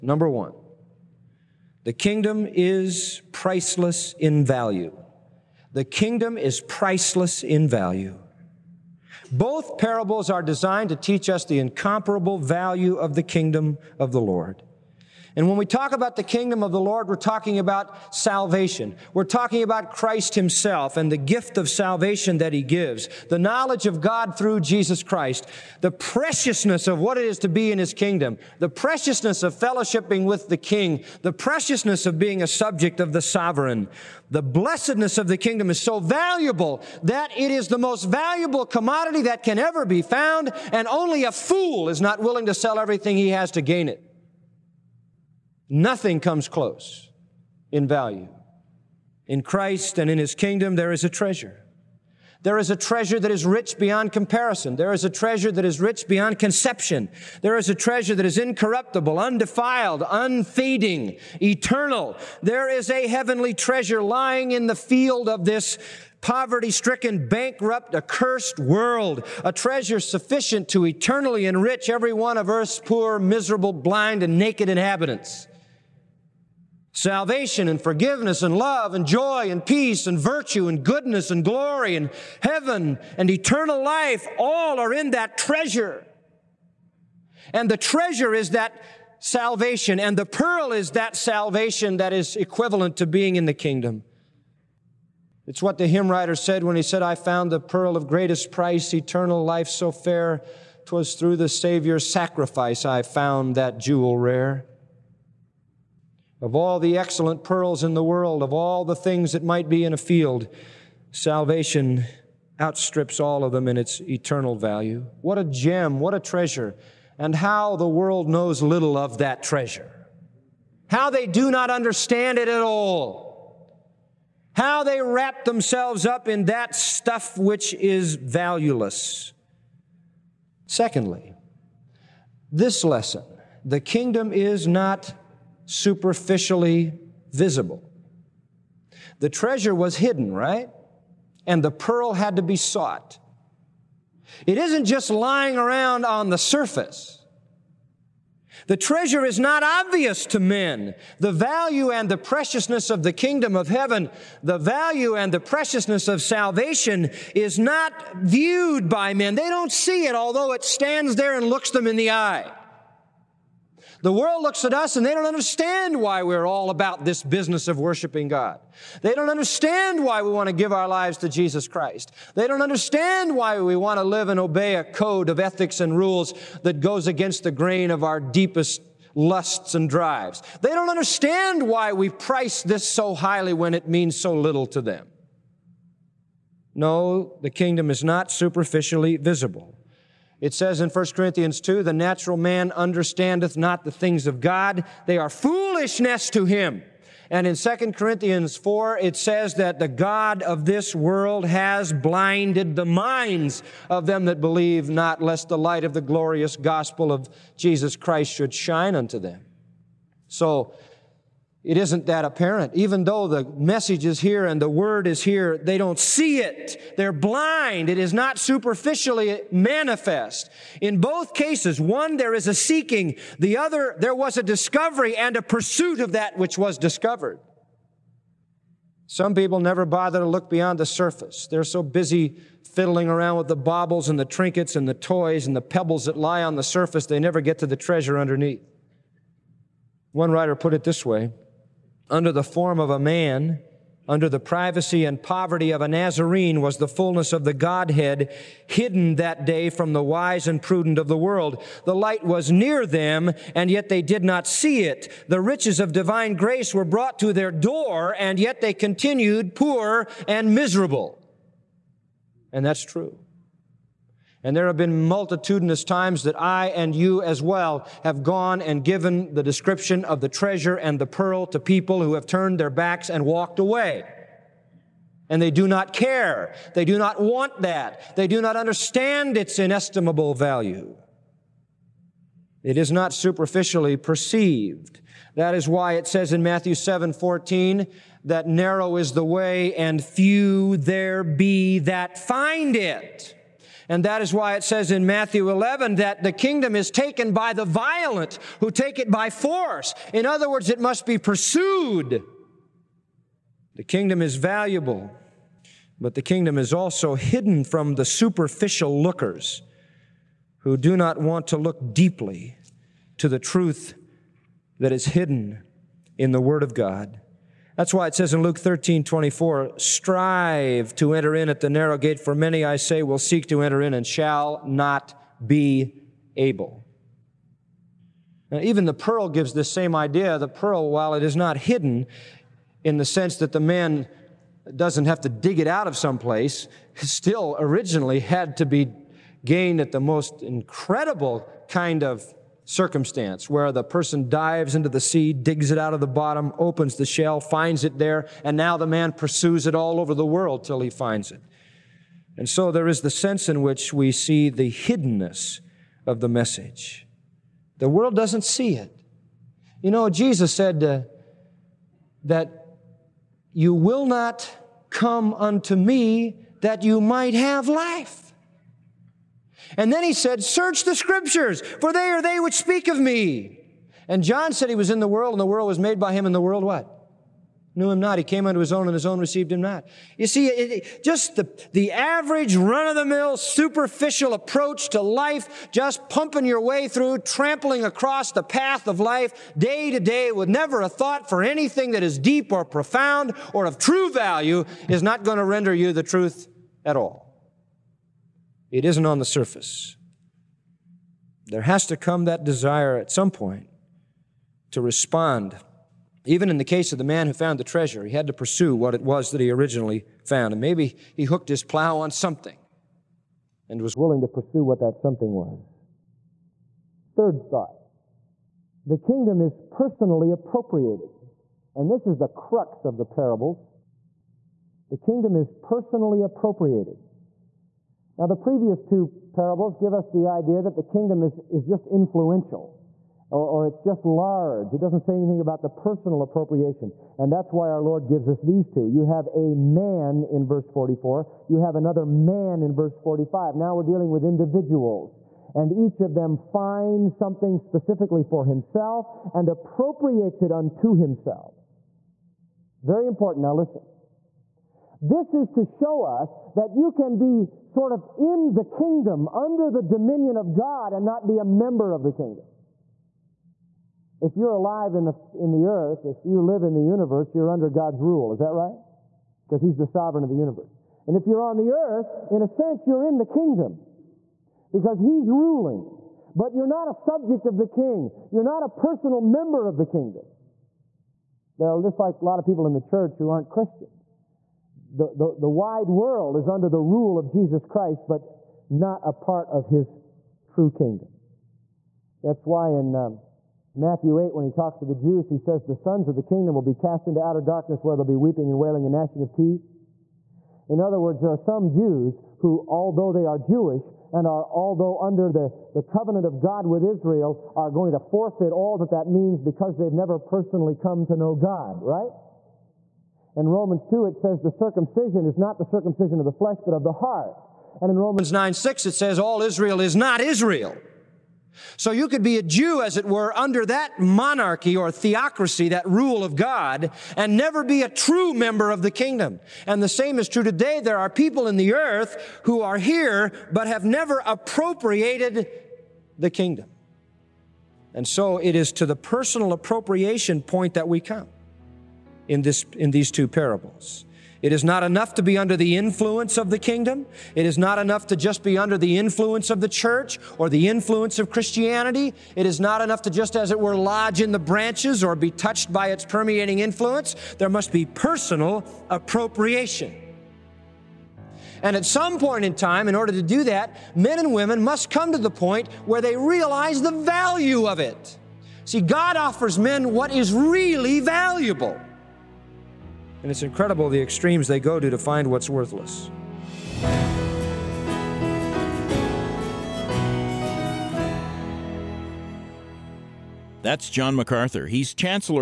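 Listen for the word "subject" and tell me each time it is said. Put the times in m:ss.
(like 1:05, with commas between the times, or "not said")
0:32, 7:56.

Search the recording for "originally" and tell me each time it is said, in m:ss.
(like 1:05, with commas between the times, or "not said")
5:37, 6:49.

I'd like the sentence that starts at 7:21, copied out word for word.
You have another man in verse 45.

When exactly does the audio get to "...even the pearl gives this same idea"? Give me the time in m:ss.
5:28.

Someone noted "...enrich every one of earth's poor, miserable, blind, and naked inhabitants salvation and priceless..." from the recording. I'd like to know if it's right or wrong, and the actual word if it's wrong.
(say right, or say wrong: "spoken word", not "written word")
wrong: "forgiveness", not "priceless".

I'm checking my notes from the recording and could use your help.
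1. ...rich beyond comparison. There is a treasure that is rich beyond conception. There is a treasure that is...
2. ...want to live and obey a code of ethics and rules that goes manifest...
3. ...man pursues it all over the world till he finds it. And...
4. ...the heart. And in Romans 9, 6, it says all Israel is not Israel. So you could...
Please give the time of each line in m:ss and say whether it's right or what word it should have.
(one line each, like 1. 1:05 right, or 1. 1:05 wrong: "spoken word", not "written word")
1. 0:53 right
2. 2:53 wrong: "against", not "manifest"
3. 5:48 right
4. 8:36 right.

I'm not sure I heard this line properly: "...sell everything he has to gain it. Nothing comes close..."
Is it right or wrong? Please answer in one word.
right.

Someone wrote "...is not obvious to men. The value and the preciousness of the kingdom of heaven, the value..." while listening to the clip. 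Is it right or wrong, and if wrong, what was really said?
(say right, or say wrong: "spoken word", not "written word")
right.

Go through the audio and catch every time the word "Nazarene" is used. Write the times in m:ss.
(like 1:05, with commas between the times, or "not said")
4:05.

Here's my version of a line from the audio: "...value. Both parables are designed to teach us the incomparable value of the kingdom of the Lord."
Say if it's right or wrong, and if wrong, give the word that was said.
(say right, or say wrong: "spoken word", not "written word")
right.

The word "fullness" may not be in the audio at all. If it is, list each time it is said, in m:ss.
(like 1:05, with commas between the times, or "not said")
4:06.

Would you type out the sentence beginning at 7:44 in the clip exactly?
If you're alive in the, in the earth, if you live in the universe, you're under God's rule.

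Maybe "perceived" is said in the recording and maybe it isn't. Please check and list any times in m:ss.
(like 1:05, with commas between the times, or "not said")
4:43.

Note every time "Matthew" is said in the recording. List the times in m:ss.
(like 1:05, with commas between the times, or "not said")
4:46, 4:55, 8:13.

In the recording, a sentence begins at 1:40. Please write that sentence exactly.
'Twas through the Savior's sacrifice I found that jewel rare.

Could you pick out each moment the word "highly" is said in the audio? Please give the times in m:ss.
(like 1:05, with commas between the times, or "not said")
3:03.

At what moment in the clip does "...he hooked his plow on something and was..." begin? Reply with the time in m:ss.
6:51.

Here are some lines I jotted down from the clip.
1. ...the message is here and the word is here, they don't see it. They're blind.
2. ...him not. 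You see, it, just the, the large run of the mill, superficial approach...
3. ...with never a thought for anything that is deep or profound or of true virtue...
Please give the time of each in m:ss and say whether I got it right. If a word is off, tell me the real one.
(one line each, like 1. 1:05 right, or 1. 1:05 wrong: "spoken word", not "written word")
1. 3:33 right
2. 6:19 wrong: "average", not "large"
3. 6:30 wrong: "value", not "virtue".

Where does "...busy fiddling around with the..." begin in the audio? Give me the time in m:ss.
3:51.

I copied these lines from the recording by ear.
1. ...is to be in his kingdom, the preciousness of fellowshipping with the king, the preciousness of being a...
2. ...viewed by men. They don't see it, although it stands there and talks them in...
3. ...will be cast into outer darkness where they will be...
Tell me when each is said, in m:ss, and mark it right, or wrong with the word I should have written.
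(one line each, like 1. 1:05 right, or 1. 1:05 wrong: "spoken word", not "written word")
1. 0:27 right
2. 2:38 wrong: "looks", not "talks"
3. 8:16 right.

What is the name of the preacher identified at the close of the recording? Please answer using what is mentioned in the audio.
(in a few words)
John MacArthur.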